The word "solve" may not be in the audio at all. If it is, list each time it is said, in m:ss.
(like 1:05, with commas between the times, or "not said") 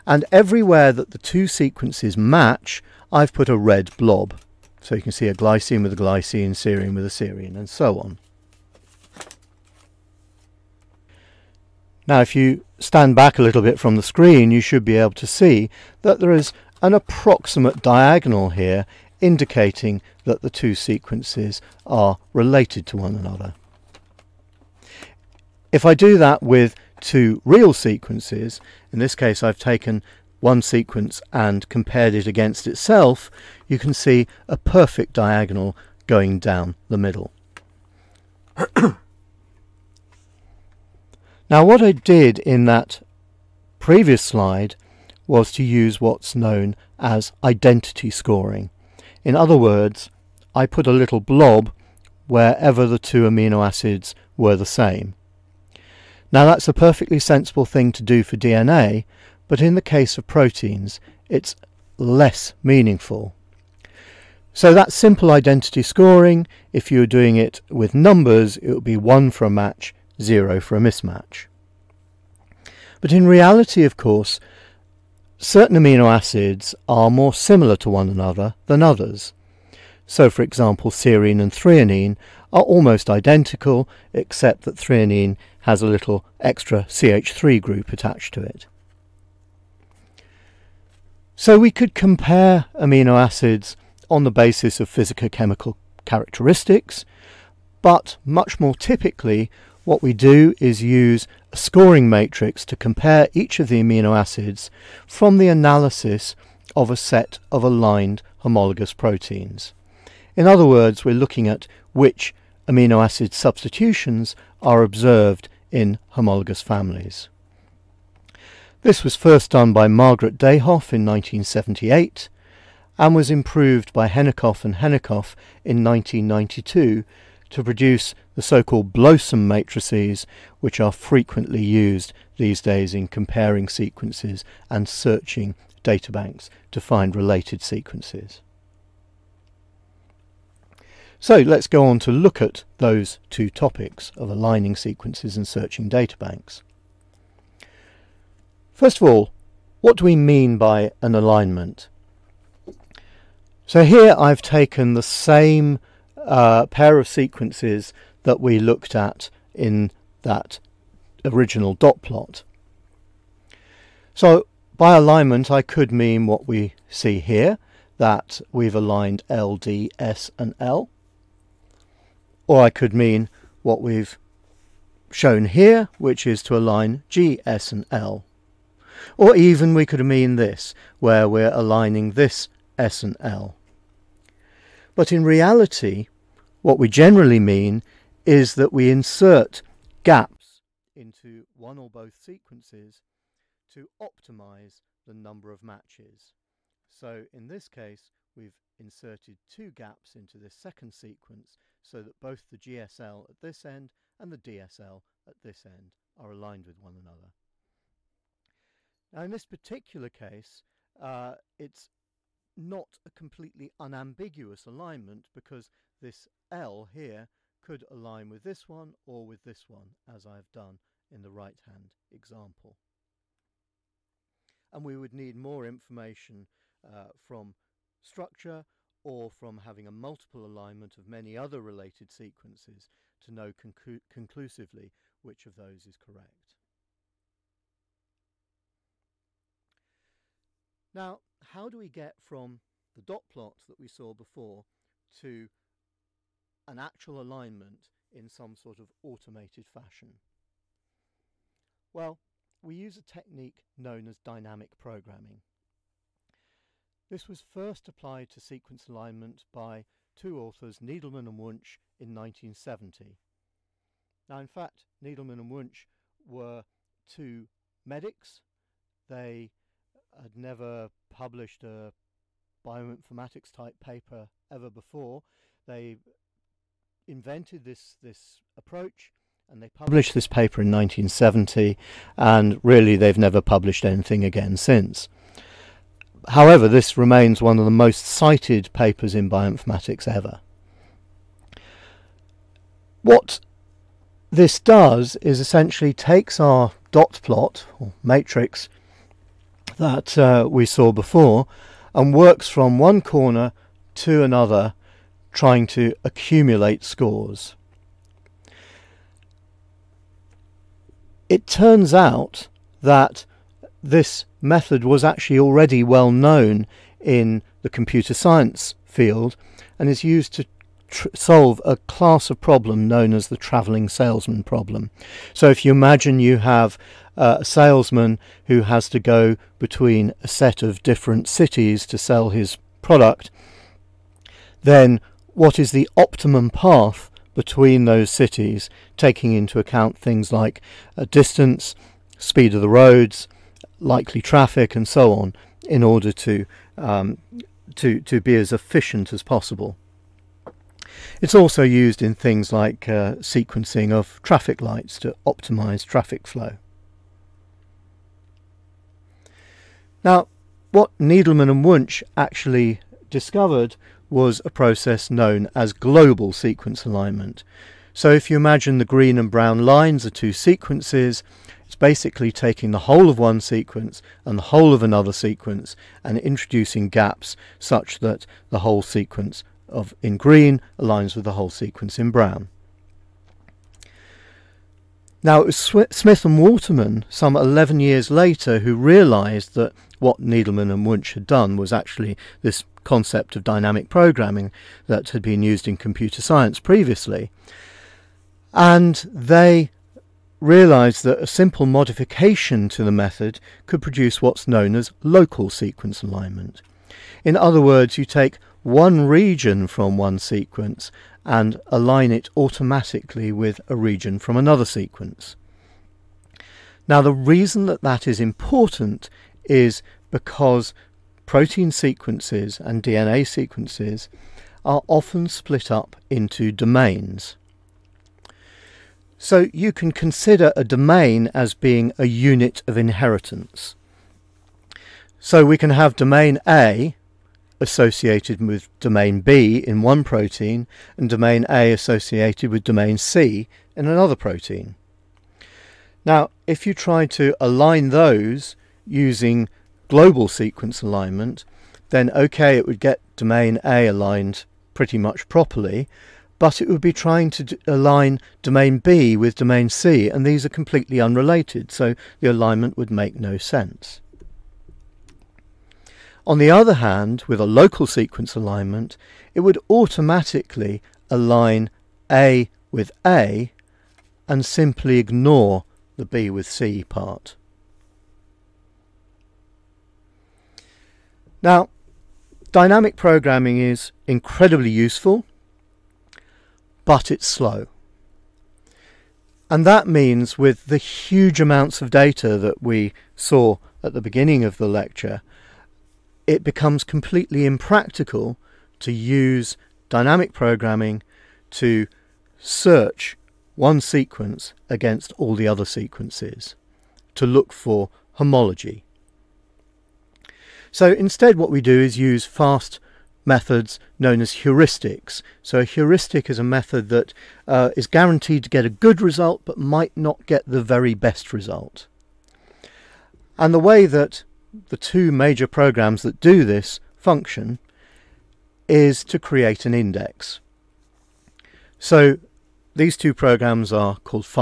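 5:21.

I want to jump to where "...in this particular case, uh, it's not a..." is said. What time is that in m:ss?
3:29.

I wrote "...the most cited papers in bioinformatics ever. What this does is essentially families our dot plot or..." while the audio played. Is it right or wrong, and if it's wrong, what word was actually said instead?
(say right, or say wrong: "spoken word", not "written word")
wrong: "takes", not "families".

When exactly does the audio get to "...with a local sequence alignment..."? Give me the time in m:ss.
7:47.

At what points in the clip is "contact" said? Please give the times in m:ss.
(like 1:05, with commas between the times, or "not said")
not said.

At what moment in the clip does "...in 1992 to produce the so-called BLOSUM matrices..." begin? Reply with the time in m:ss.
2:05.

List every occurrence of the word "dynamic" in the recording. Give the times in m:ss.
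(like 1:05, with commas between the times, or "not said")
4:14, 6:33, 8:02, 8:19.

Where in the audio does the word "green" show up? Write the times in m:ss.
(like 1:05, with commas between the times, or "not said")
6:08, 6:20.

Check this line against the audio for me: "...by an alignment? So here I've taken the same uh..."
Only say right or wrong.
right.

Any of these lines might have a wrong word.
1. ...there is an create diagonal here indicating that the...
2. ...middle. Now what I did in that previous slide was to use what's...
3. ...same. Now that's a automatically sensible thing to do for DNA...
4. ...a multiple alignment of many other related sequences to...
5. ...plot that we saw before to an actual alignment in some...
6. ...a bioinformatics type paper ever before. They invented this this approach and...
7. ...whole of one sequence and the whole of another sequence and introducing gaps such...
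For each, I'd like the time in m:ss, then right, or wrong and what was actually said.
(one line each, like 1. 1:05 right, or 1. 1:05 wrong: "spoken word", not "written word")
1. 0:16 wrong: "approximate", not "create"
2. 0:36 right
3. 0:54 wrong: "perfectly", not "automatically"
4. 3:49 right
5. 4:03 right
6. 4:31 right
7. 6:12 right.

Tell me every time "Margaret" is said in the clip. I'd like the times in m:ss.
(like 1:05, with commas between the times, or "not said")
1:59.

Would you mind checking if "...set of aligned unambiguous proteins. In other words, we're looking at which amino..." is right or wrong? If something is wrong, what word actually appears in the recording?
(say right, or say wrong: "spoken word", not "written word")
wrong: "homologous", not "unambiguous".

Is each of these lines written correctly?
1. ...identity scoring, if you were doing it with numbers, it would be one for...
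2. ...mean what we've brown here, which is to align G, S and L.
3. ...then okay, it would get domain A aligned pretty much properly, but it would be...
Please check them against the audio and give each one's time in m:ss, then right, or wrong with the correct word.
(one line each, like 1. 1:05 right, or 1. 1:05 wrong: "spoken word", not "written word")
1. 1:05 right
2. 2:52 wrong: "shown", not "brown"
3. 7:31 right.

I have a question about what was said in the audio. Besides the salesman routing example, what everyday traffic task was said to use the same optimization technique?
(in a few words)
Sequencing of traffic lights.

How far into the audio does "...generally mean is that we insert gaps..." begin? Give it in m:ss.
3:06.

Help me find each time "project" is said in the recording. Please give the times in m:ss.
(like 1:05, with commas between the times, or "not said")
not said.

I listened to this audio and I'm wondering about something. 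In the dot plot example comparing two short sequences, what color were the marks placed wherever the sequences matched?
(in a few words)
Red.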